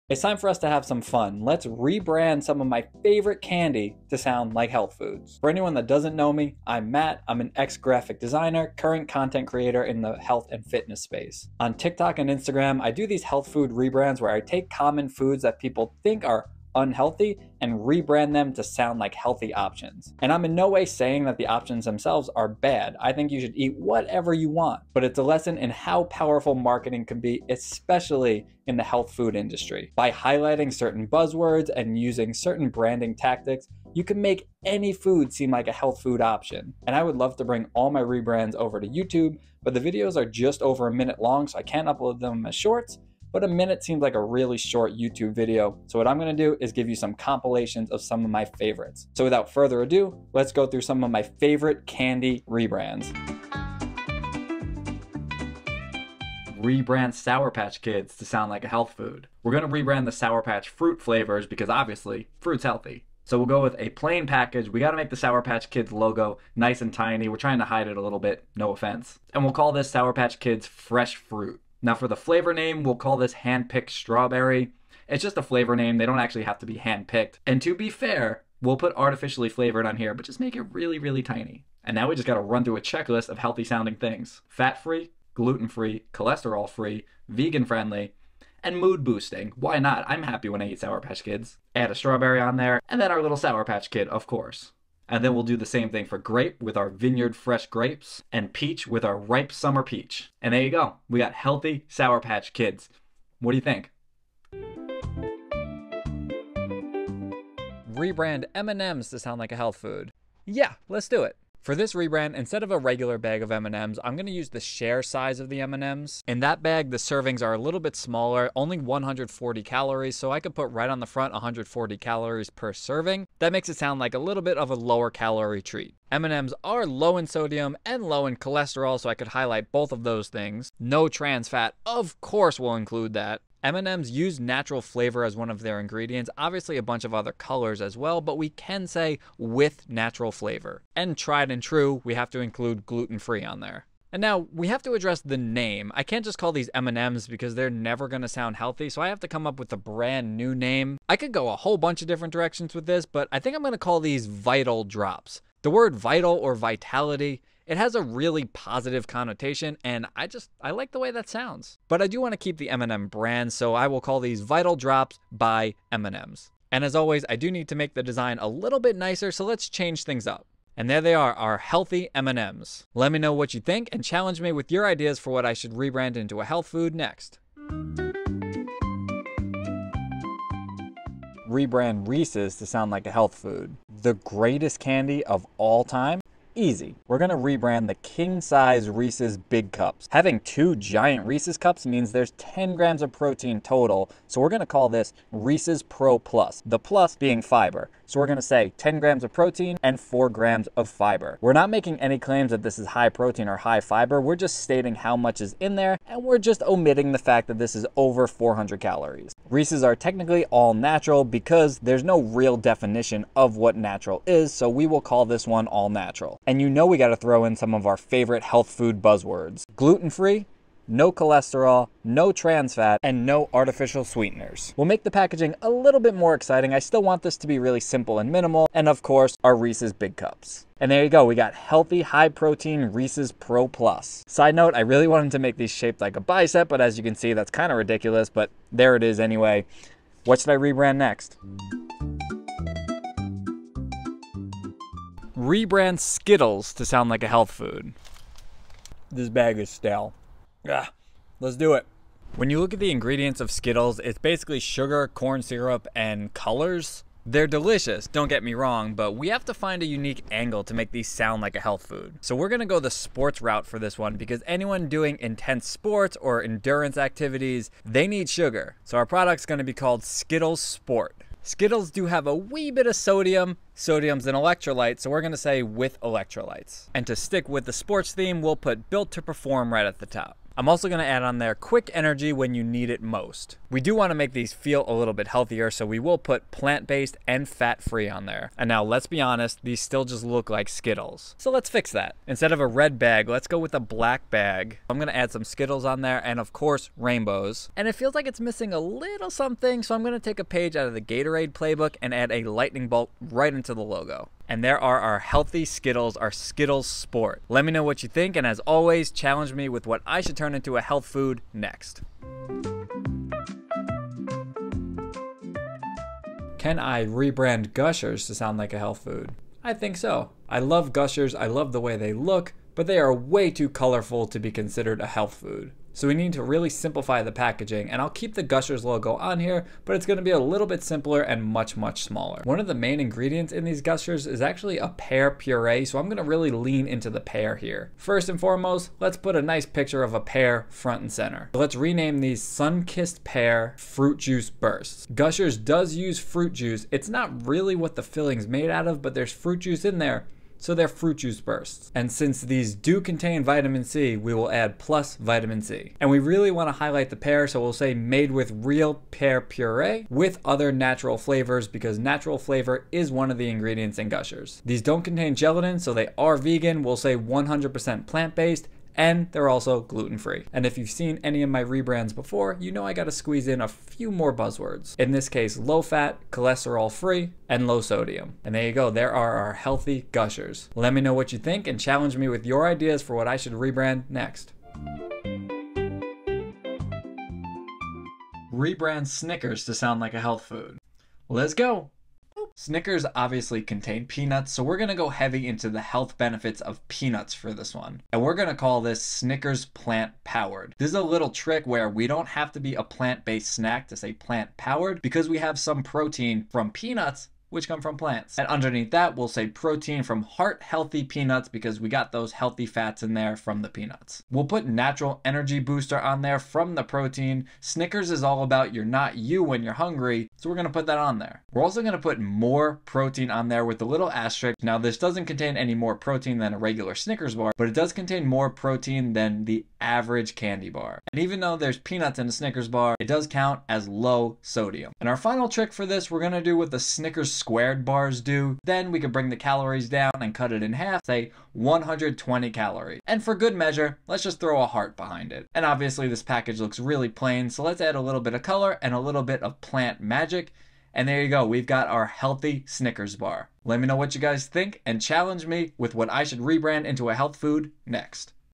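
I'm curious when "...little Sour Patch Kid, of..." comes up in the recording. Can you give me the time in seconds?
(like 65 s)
93 s.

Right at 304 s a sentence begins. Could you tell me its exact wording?
And there are our healthy Skittles, our Skittles Sport.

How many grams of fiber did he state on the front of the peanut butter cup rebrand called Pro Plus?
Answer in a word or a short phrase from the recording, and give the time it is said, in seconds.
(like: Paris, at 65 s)
4, at 199 s.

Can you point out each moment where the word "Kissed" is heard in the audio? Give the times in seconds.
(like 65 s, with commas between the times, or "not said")
342 s.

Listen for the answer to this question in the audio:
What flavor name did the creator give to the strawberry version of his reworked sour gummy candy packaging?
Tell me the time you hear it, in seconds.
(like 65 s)
73 s.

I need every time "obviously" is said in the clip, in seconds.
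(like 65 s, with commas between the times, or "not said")
61 s, 136 s, 393 s, 445 s.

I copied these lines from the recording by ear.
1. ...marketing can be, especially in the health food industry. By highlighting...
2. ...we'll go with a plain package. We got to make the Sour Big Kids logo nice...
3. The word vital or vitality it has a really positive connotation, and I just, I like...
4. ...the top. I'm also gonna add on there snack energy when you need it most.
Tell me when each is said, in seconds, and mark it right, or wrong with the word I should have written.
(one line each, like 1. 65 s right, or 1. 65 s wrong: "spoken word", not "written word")
1. 26 s right
2. 63 s wrong: "Patch", not "Big"
3. 155 s right
4. 279 s wrong: "quick", not "snack".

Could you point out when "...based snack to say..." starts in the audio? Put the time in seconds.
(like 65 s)
403 s.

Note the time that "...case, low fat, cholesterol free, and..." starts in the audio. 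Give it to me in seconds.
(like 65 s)
375 s.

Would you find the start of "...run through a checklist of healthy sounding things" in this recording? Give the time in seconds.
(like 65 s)
82 s.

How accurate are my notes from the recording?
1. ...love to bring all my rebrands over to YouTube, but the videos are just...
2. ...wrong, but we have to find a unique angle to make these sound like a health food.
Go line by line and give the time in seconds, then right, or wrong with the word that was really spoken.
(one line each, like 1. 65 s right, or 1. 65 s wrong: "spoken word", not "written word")
1. 37 s right
2. 258 s right.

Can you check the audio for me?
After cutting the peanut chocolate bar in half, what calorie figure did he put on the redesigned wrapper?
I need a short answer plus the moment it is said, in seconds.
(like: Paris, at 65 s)
120, at 441 s.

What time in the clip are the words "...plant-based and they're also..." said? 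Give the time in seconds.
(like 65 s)
368 s.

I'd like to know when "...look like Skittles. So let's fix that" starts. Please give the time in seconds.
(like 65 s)
290 s.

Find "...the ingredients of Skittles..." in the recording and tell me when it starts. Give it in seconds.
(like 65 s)
252 s.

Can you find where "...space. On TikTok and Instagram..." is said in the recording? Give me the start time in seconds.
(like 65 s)
11 s.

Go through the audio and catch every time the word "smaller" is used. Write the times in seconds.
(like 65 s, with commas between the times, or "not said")
117 s, 332 s.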